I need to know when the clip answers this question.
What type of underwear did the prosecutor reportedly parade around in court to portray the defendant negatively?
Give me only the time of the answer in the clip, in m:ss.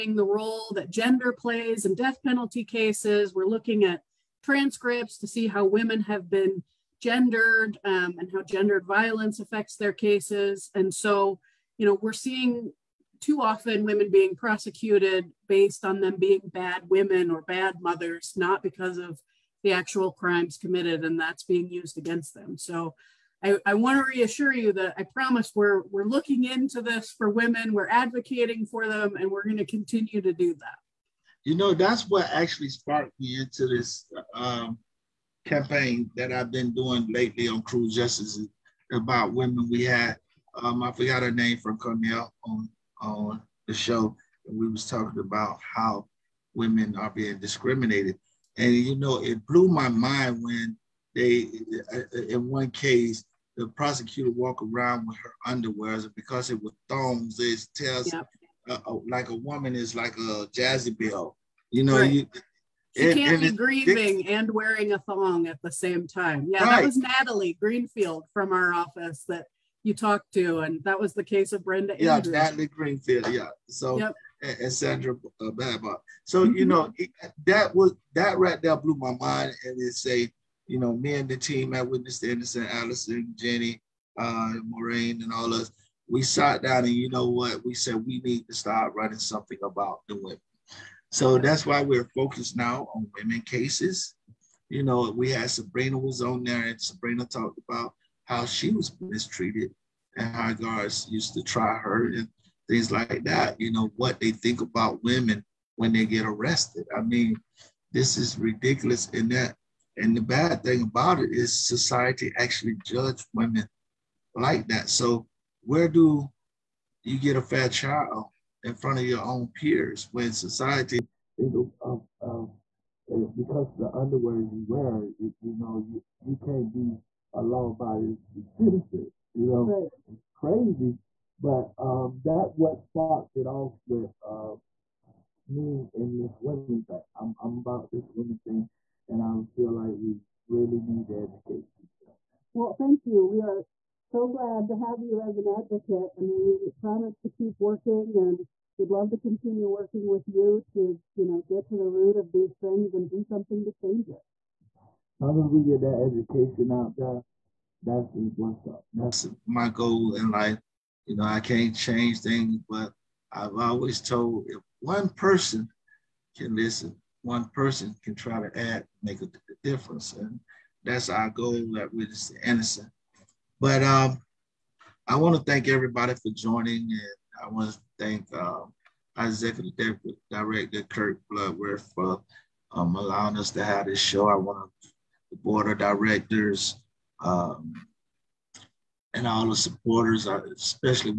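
0:56.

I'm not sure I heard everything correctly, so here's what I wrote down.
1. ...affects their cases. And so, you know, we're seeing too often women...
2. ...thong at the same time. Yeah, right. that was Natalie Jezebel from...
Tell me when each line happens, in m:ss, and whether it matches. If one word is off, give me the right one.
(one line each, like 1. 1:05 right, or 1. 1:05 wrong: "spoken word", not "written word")
1. 0:09 right
2. 1:04 wrong: "Greenfield", not "Jezebel".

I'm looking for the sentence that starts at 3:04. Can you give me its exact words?
I want the board of directors um, and all the supporters.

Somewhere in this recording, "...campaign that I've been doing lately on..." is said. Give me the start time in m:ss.
0:35.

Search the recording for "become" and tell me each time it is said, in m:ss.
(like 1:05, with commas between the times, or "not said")
not said.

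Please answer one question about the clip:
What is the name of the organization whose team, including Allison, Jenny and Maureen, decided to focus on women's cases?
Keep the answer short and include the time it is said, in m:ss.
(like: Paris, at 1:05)
Witness to Innocence, at 1:21.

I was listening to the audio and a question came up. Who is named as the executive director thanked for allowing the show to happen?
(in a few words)
Kirk Bloodsworth.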